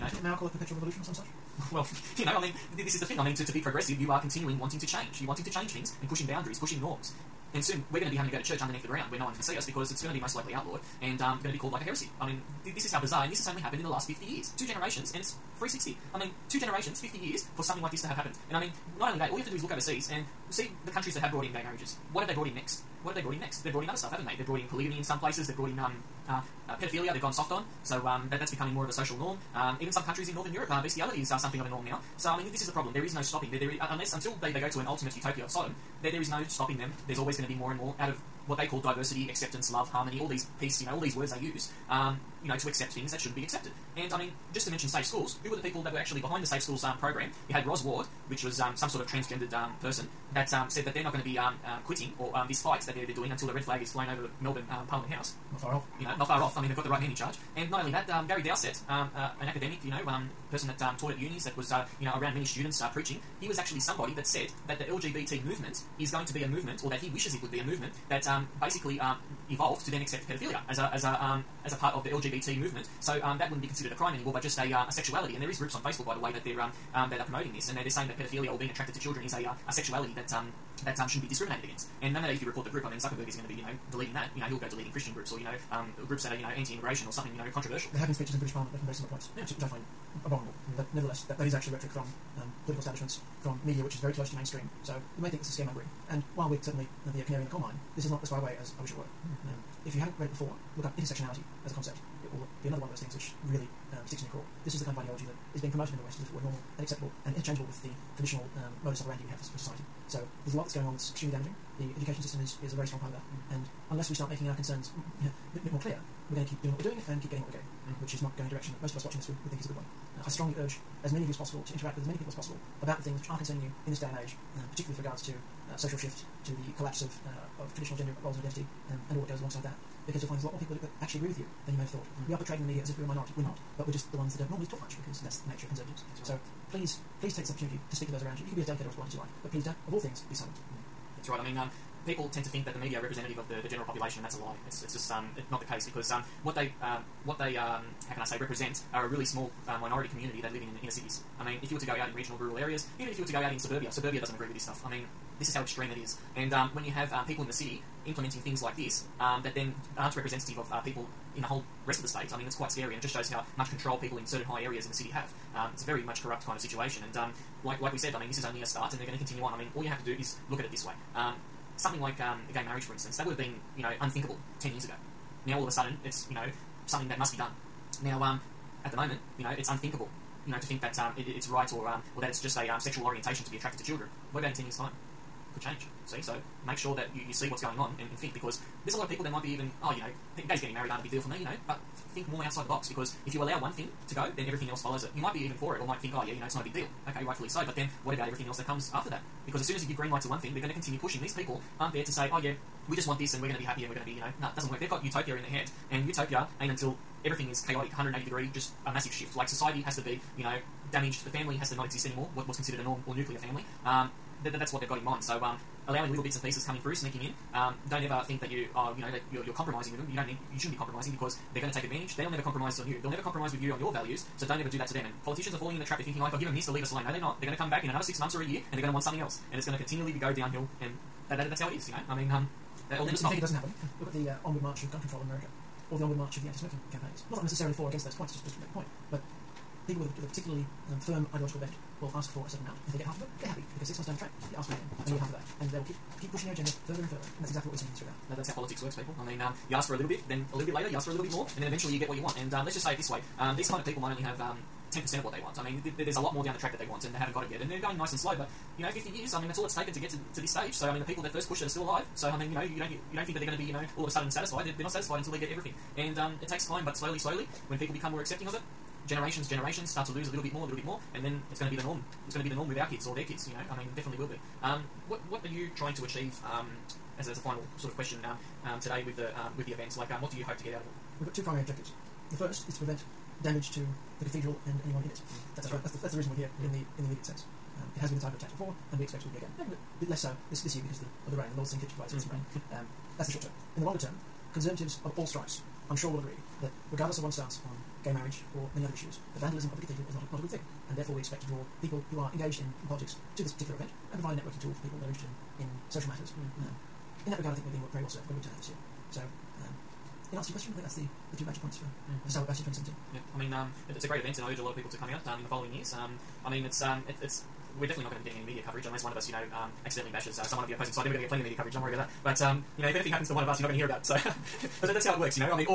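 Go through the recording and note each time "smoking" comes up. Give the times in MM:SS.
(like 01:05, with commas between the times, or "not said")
03:56.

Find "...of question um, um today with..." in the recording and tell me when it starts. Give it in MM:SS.
04:37.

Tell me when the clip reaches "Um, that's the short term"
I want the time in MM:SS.
04:52.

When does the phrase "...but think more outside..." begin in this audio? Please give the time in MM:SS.
03:11.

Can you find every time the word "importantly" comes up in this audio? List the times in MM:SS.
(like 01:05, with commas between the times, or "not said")
not said.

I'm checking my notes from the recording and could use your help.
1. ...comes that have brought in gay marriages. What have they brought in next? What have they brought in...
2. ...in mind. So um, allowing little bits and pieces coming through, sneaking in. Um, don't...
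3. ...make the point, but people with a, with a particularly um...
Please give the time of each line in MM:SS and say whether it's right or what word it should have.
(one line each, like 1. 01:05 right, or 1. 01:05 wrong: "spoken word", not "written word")
1. 00:20 wrong: "countries", not "comes"
2. 03:34 right
3. 03:58 right.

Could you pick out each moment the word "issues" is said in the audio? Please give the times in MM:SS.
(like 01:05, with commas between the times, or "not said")
04:58.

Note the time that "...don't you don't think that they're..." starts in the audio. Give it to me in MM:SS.
04:22.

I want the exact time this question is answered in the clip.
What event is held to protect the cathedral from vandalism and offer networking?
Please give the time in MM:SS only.
05:12.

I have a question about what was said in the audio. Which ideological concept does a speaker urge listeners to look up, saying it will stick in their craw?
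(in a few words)
Intersectionality.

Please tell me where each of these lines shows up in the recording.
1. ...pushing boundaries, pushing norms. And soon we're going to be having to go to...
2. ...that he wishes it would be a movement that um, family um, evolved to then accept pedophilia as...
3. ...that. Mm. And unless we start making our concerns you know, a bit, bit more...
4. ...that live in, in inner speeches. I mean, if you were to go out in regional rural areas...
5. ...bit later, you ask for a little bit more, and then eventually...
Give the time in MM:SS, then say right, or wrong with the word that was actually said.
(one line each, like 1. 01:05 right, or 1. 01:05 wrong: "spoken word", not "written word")
1. 00:06 right
2. 01:06 wrong: "basically", not "family"
3. 01:53 right
4. 02:30 wrong: "cities", not "speeches"
5. 04:10 right.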